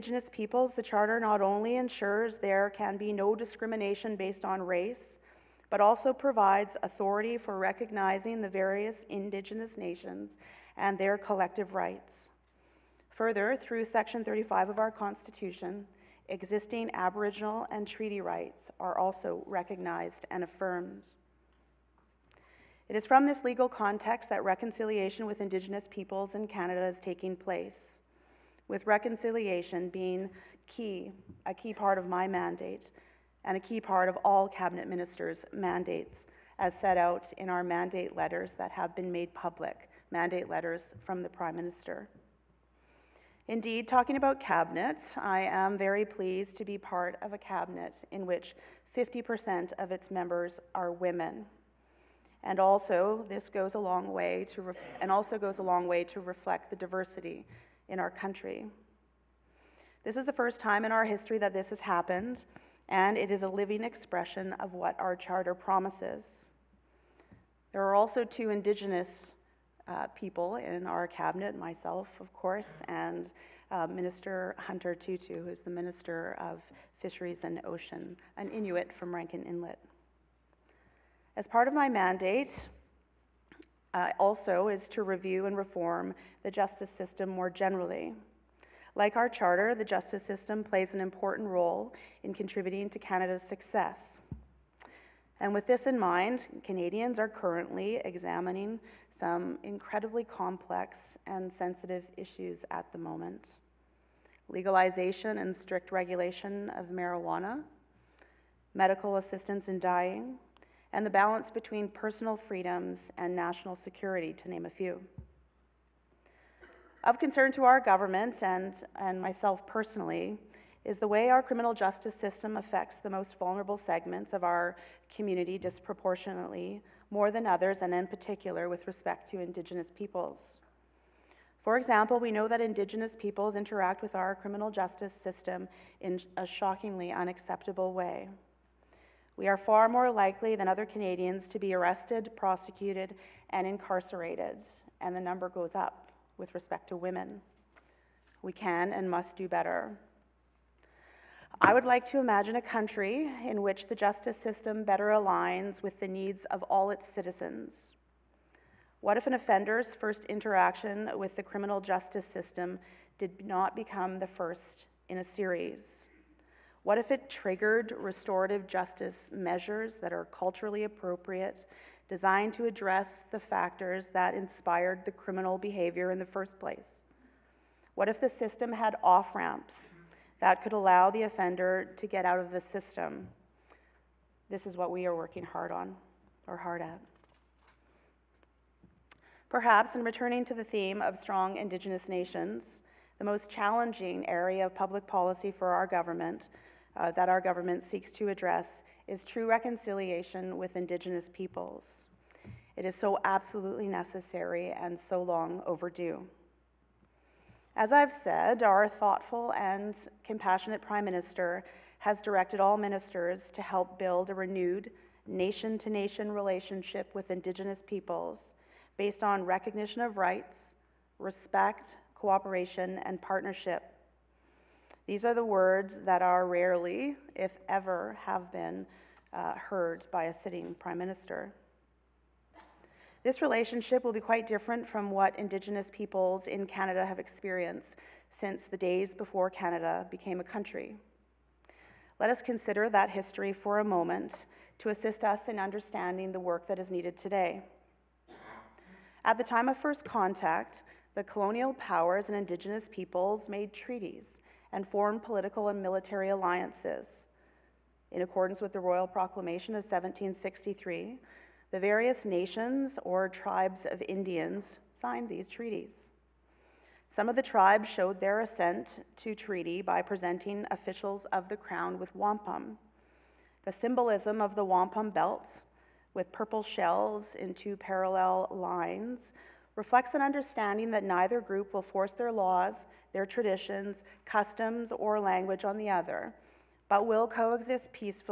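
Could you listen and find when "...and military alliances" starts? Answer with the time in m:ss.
4:15.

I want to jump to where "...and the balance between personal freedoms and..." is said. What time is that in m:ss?
1:50.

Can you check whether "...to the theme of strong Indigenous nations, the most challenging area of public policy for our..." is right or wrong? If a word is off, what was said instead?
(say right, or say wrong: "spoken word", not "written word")
right.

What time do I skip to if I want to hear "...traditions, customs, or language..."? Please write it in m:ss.
4:43.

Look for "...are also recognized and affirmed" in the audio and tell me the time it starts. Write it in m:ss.
0:18.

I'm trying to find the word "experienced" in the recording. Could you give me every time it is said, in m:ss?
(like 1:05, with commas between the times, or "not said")
3:57.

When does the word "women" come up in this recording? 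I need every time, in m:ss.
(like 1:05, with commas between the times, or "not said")
0:50, 2:26.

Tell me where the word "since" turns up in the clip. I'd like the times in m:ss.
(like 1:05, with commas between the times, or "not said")
3:58.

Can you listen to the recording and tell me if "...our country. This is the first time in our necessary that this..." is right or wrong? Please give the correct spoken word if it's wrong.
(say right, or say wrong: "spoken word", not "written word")
wrong: "history", not "necessary".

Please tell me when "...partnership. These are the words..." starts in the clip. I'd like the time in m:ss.
3:43.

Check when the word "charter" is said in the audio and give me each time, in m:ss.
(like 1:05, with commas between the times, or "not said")
0:00, 1:05, 1:29.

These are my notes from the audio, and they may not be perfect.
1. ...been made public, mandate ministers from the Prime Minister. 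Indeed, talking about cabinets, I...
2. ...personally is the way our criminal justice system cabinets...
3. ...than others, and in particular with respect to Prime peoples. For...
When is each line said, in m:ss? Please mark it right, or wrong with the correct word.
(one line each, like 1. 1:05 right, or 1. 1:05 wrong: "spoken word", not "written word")
1. 0:38 wrong: "letters", not "ministers"
2. 1:59 wrong: "affects", not "cabinets"
3. 2:07 wrong: "Indigenous", not "Prime".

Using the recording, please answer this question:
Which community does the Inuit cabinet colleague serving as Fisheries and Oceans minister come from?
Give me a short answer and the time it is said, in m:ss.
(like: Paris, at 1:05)
Rankin Inlet, at 1:19.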